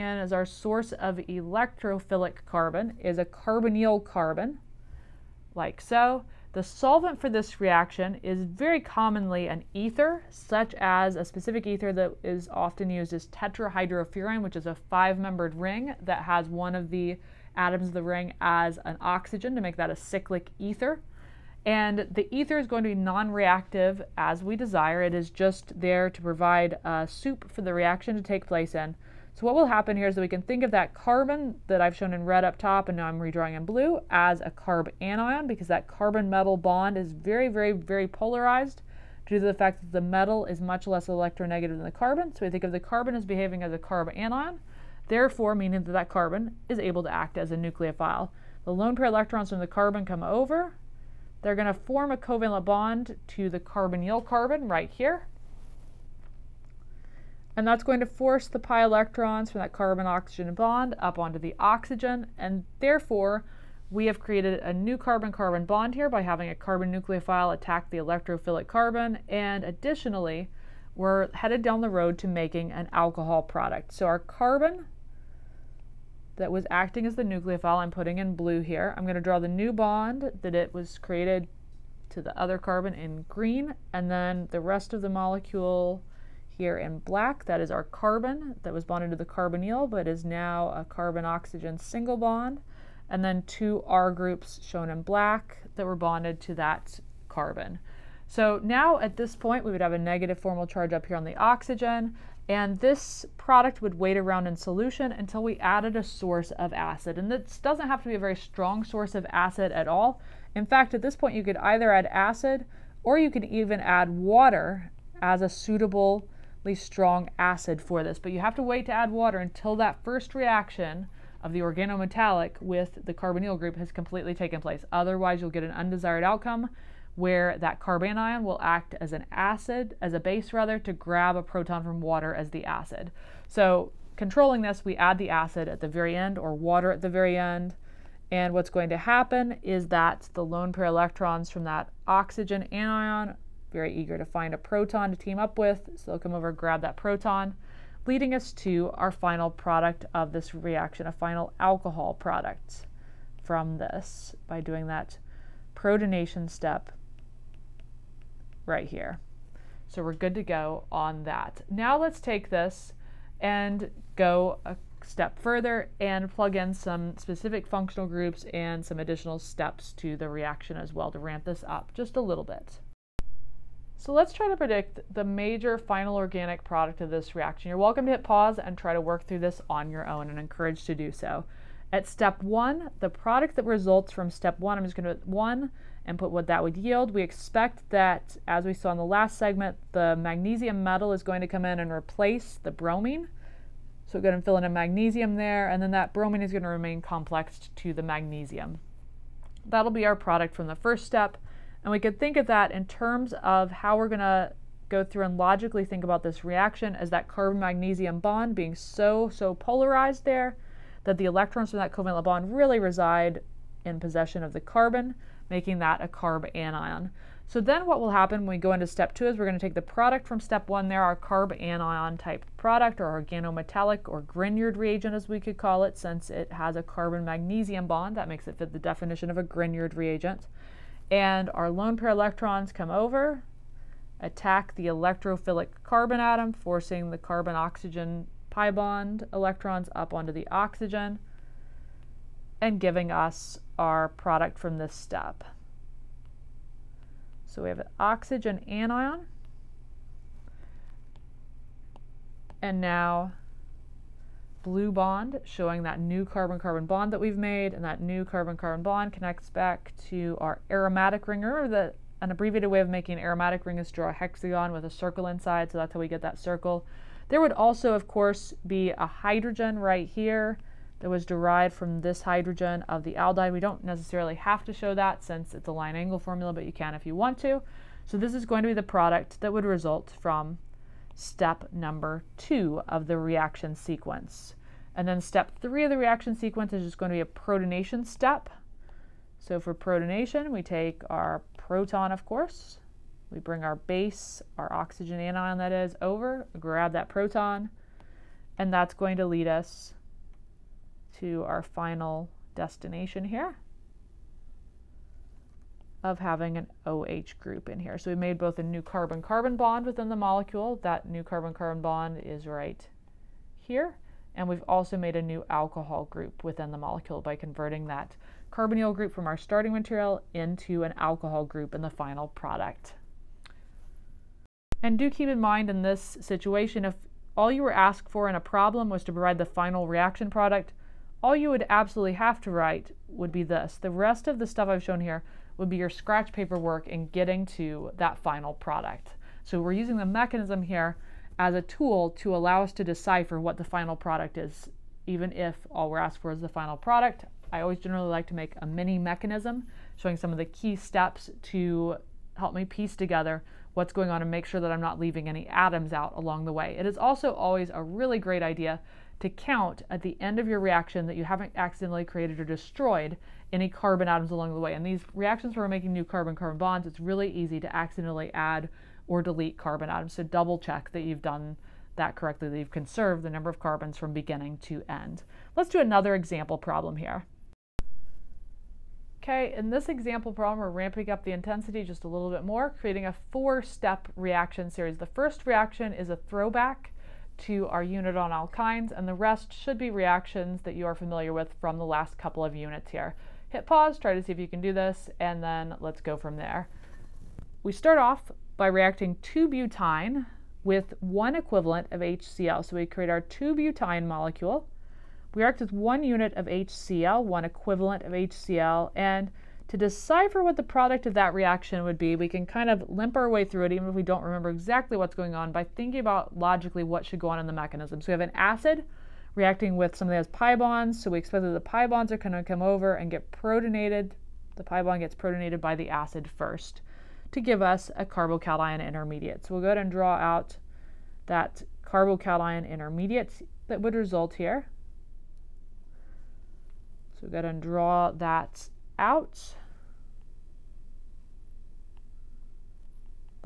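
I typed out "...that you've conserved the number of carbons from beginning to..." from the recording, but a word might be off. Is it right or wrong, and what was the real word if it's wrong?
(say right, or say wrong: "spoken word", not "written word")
right.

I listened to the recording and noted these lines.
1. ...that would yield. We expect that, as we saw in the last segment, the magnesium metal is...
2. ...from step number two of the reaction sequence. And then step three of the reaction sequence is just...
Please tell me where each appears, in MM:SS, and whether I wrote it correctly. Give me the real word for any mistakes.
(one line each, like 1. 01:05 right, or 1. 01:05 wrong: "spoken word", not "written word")
1. 03:06 right
2. 04:40 right.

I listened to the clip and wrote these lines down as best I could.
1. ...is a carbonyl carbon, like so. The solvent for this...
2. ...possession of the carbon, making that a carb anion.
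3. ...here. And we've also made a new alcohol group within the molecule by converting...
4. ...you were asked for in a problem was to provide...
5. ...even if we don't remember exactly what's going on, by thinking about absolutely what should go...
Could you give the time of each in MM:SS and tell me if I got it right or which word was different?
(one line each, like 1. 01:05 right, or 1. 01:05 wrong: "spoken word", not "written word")
1. 00:02 right
2. 03:33 right
3. 05:13 right
4. 05:27 right
5. 06:53 wrong: "logically", not "absolutely".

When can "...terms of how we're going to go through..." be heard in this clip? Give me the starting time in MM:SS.
03:22.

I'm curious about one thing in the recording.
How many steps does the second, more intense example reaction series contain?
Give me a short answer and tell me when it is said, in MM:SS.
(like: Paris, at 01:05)
4, at 06:23.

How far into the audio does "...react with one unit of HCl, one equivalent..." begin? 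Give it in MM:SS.
06:45.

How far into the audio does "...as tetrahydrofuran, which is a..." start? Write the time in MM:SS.
00:13.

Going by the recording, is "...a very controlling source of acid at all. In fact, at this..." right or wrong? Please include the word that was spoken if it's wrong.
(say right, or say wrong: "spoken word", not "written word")
wrong: "strong", not "controlling".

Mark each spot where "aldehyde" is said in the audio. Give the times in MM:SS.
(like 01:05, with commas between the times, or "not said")
04:33.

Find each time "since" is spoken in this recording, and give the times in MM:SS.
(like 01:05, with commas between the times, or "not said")
03:45, 04:35.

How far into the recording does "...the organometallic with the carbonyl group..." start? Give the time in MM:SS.
02:01.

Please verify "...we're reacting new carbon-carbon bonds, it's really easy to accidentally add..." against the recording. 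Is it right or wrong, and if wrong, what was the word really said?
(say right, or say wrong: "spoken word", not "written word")
wrong: "making", not "reacting".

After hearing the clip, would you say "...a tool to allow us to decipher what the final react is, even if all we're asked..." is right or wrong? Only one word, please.
wrong.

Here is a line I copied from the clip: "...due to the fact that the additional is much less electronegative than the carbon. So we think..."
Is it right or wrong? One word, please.
wrong.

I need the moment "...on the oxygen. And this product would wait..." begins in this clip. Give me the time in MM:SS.
01:41.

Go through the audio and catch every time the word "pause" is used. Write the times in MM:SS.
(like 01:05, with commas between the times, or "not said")
02:58, 06:33.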